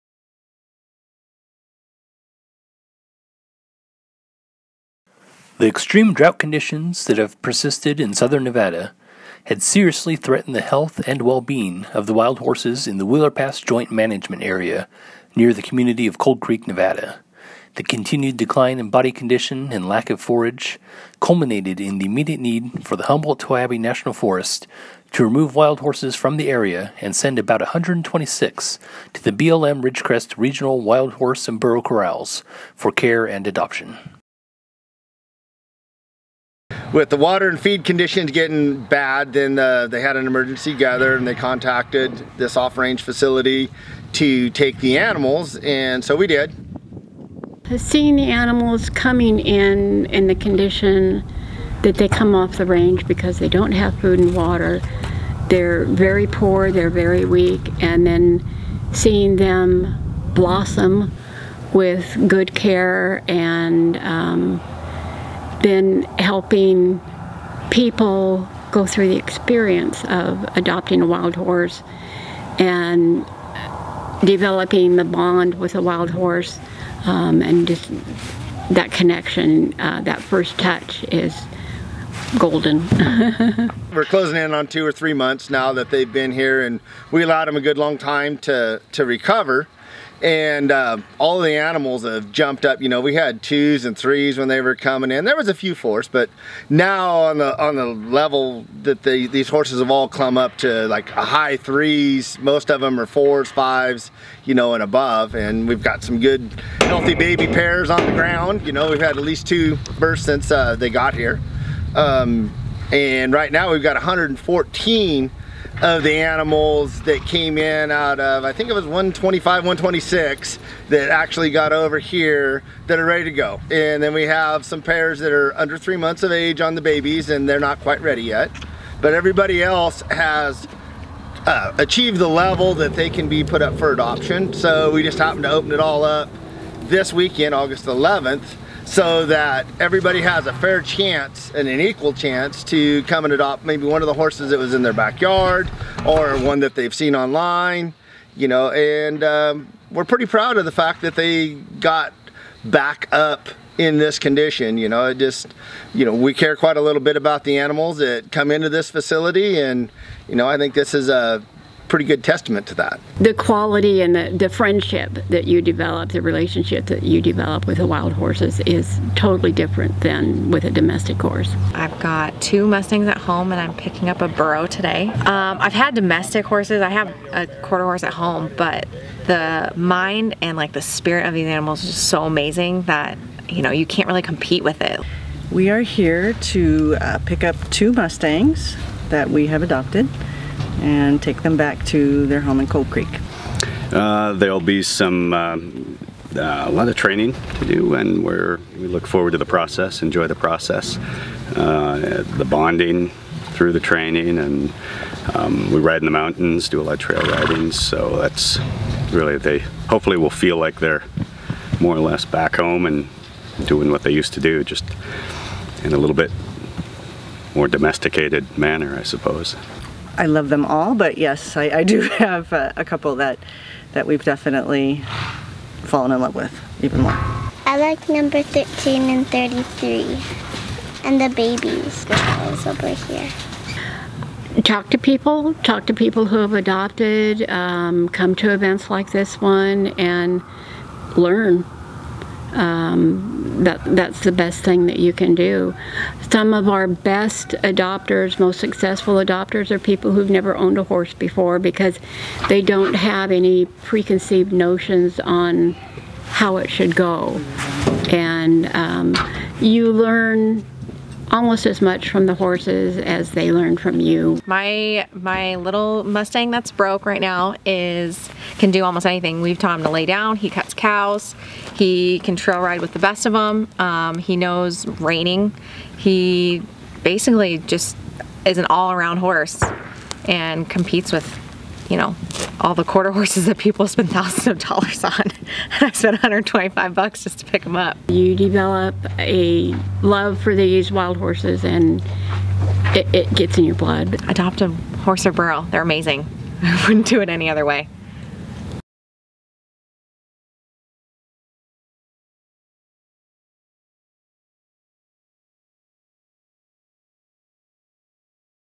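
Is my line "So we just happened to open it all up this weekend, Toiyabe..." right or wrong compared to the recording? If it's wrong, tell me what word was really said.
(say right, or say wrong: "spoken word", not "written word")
wrong: "August", not "Toiyabe".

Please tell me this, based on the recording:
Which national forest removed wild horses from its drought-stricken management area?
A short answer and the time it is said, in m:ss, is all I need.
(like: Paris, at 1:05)
Humboldt Toiyabe National Forest, at 0:23.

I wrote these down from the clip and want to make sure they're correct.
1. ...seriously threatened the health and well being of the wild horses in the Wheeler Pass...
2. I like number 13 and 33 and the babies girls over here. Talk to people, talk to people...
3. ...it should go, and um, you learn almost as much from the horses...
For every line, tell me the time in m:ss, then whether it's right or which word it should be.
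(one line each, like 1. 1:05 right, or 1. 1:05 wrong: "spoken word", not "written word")
1. 0:09 right
2. 3:47 right
3. 4:16 right.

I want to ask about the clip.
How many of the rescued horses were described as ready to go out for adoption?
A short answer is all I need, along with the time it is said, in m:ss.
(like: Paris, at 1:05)
114, at 1:53.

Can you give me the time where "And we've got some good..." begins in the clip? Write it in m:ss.
1:45.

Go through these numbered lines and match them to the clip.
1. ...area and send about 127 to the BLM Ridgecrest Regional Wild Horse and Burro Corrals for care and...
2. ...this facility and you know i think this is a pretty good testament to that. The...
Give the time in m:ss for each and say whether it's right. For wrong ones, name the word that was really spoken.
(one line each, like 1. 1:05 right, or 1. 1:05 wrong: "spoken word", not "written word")
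1. 0:26 wrong: "126", not "127"
2. 2:38 right.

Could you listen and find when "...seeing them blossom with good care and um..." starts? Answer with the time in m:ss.
0:58.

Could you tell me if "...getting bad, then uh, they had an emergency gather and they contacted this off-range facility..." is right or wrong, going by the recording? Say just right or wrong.
right.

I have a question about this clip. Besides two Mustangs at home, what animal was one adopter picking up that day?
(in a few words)
A burro.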